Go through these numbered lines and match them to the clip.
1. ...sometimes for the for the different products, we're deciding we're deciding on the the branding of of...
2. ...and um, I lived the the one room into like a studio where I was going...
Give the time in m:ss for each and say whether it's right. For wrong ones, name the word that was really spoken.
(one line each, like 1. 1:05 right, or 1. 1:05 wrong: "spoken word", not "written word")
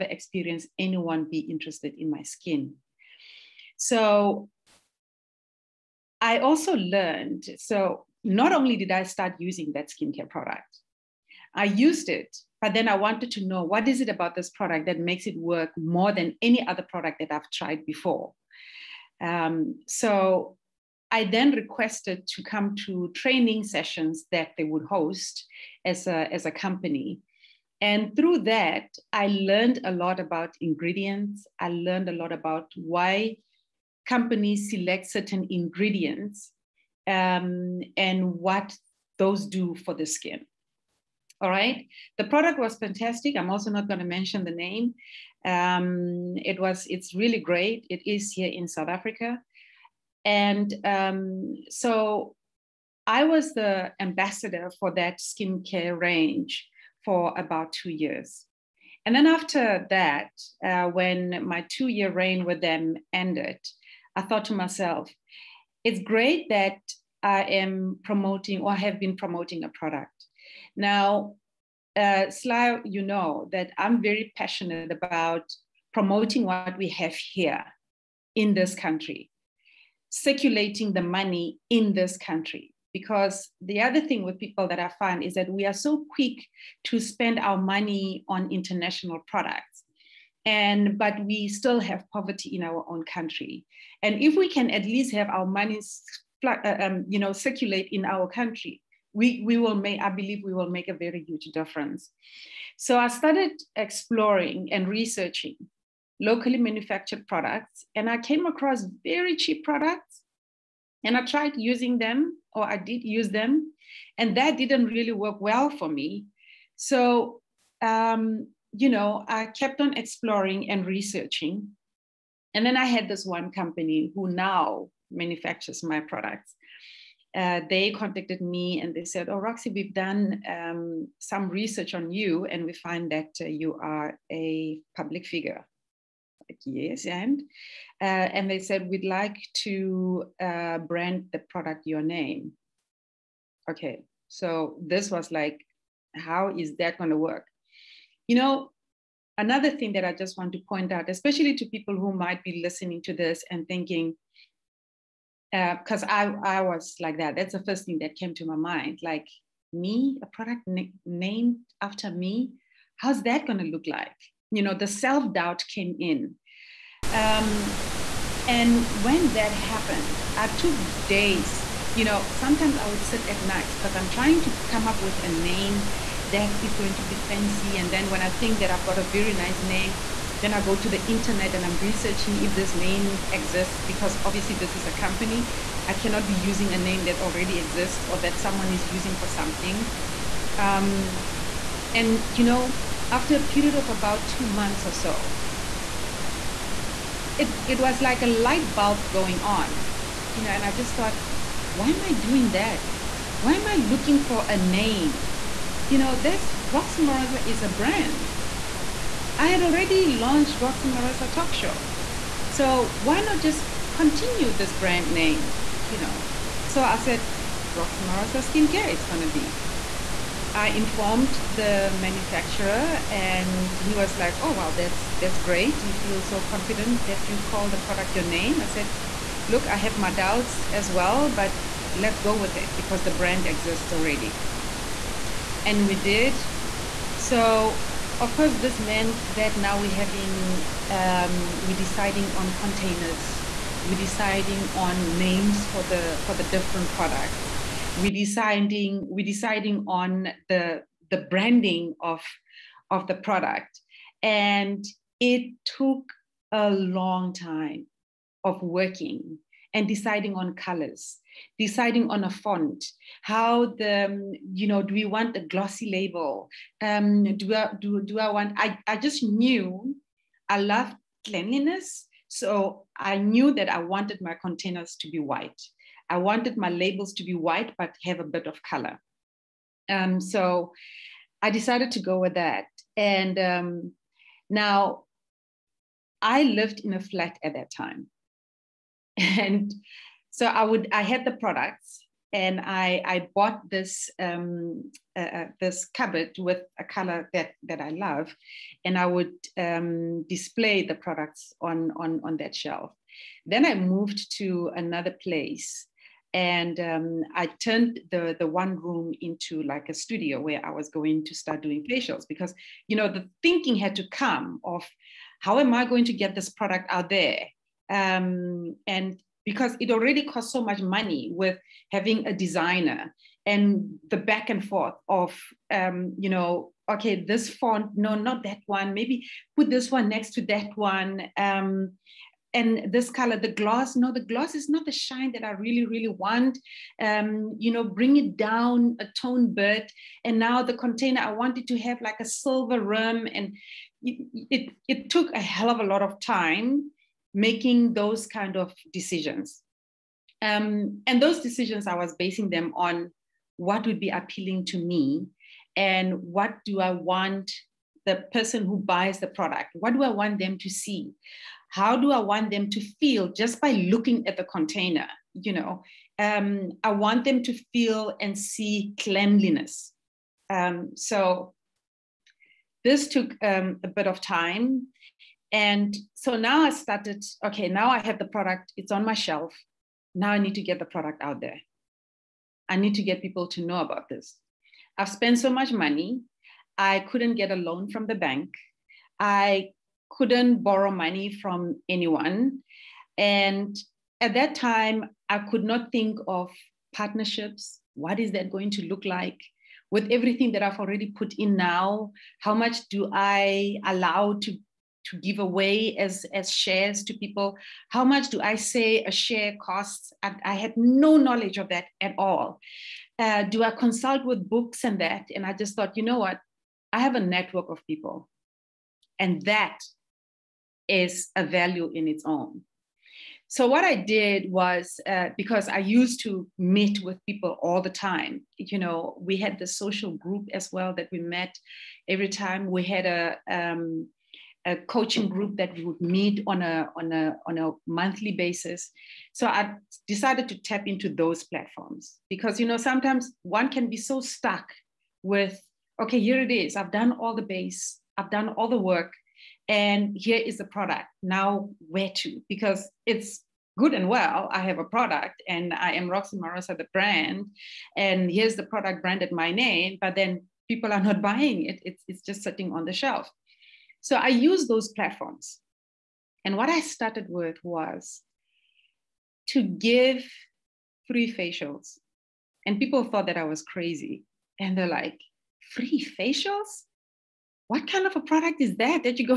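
1. 4:05 wrong: "names", not "sometimes"
2. 5:06 wrong: "turned", not "lived".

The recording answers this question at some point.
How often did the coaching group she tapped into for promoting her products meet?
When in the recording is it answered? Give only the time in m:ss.
7:17.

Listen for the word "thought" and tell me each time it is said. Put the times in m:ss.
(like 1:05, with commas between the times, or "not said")
1:04, 3:20, 6:55, 7:53.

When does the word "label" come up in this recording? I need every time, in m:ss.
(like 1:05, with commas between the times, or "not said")
4:25, 4:36.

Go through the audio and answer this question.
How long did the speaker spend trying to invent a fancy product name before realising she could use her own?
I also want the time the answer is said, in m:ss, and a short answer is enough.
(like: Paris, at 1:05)
About 2 months, at 3:13.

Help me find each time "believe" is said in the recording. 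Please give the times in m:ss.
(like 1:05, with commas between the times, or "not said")
1:40.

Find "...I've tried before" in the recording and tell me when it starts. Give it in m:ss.
0:17.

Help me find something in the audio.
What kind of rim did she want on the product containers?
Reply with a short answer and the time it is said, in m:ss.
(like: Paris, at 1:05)
Silver, at 5:42.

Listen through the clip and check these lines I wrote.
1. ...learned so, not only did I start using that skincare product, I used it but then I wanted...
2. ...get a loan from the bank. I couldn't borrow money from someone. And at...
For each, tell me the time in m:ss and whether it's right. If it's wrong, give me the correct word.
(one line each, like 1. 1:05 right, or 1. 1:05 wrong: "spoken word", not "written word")
1. 0:06 right
2. 6:27 wrong: "anyone", not "someone".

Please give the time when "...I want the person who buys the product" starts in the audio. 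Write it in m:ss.
5:56.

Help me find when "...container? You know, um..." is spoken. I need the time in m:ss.
6:04.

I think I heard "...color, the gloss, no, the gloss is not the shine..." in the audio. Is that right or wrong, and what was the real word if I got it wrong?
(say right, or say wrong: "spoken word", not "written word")
right.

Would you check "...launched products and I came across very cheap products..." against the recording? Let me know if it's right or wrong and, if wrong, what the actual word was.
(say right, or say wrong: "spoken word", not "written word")
wrong: "manufactured", not "launched".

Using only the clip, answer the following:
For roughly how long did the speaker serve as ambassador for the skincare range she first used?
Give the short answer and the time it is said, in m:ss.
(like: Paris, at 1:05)
2 years, at 0:57.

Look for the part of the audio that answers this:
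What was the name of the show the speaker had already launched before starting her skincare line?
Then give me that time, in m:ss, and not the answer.
3:30.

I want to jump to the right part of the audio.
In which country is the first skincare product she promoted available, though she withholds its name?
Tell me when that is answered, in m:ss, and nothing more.
0:48.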